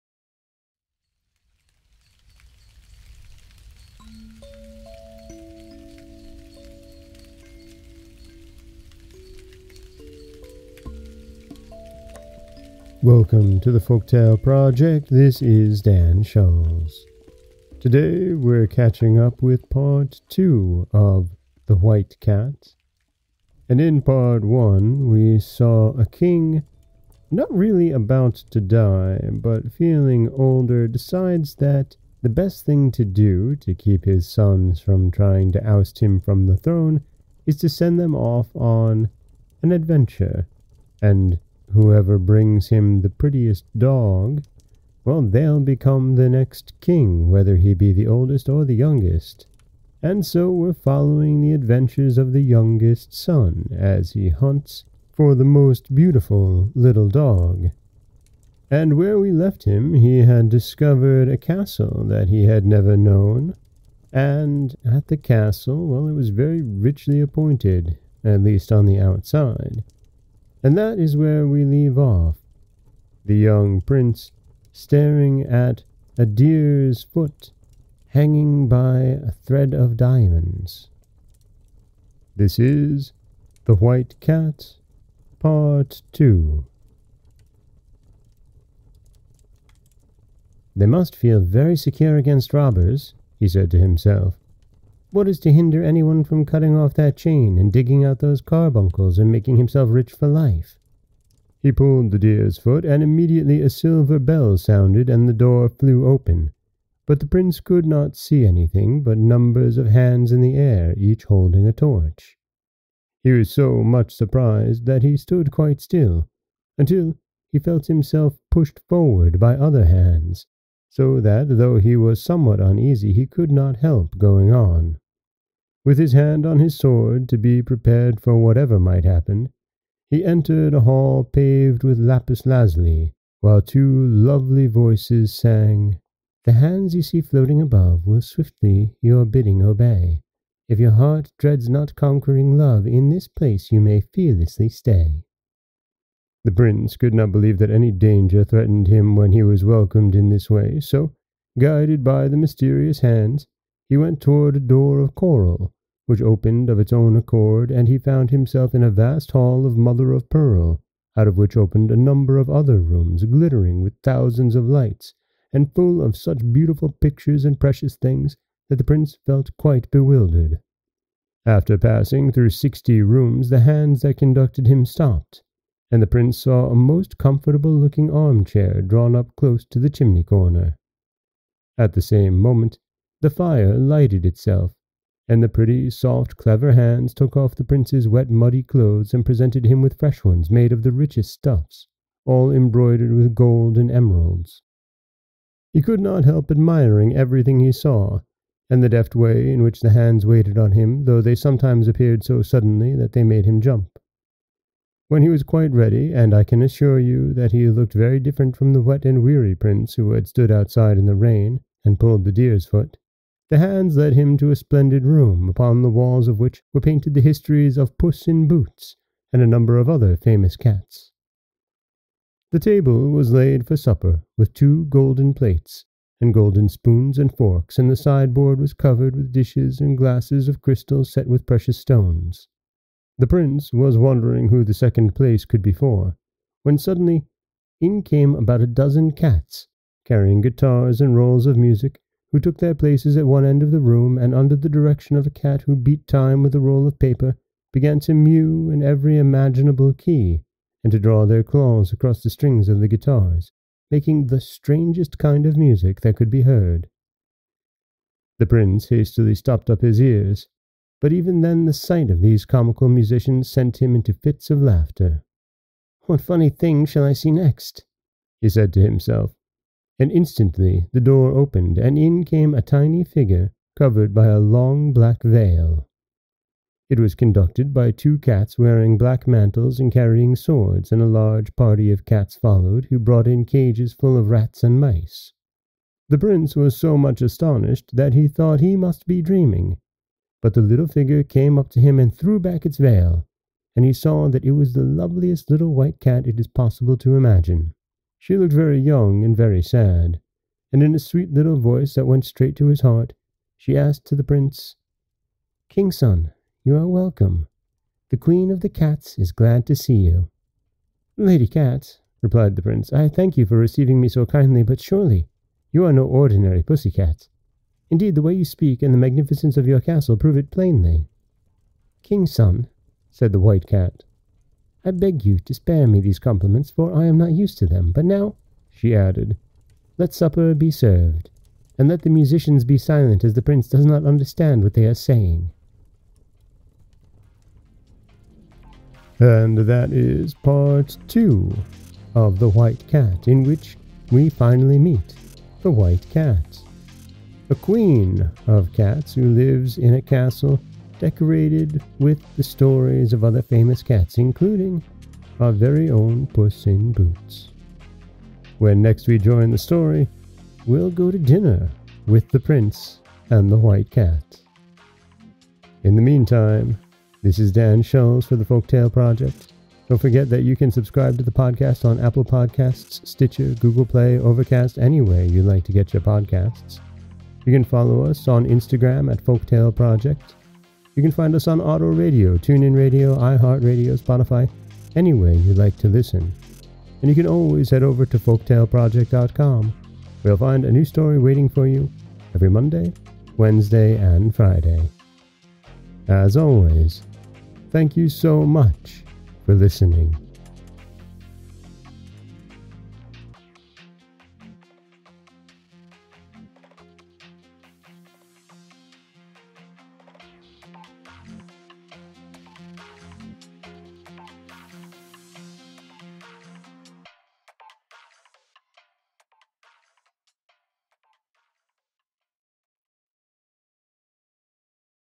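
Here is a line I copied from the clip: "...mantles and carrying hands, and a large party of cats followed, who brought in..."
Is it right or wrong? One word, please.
wrong.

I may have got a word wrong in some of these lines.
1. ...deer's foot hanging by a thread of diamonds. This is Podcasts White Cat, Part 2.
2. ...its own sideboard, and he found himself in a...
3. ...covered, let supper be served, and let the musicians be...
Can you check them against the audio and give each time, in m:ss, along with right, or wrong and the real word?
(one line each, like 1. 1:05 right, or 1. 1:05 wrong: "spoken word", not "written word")
1. 1:16 wrong: "The", not "Podcasts"
2. 2:36 wrong: "accord", not "sideboard"
3. 5:28 wrong: "added", not "covered".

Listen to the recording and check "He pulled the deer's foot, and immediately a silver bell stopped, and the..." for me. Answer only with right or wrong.
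wrong.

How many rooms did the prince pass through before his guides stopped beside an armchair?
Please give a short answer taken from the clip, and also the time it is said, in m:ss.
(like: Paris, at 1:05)
60, at 2:52.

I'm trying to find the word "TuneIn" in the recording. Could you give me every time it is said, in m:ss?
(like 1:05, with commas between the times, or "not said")
6:22.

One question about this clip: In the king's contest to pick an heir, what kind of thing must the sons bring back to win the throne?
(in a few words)
prettiest dog.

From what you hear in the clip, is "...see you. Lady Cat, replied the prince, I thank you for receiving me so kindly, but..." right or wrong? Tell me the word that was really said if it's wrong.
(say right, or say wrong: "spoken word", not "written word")
right.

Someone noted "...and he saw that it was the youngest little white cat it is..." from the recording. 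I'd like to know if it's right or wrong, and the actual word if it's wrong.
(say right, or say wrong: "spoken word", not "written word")
wrong: "loveliest", not "youngest".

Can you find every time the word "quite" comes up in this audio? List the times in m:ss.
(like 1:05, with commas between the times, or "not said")
1:55, 2:49, 3:25.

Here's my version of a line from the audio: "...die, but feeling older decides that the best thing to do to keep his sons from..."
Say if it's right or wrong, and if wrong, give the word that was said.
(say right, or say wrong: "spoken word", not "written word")
right.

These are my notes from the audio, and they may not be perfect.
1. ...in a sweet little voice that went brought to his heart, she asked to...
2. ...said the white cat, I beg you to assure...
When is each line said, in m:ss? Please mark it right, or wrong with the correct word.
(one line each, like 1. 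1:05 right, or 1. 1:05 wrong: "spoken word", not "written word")
1. 5:00 wrong: "straight", not "brought"
2. 5:23 wrong: "spare", not "assure".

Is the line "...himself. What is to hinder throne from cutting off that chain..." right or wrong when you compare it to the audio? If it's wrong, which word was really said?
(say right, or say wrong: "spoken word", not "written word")
wrong: "anyone", not "throne".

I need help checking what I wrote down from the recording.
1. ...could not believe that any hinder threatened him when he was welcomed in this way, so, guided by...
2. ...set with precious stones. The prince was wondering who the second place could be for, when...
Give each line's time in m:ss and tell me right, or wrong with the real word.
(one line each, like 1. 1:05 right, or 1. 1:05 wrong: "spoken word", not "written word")
1. 2:26 wrong: "danger", not "hinder"
2. 3:51 right.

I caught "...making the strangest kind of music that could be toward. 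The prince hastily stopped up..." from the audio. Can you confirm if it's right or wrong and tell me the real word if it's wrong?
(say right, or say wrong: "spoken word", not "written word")
wrong: "heard", not "toward".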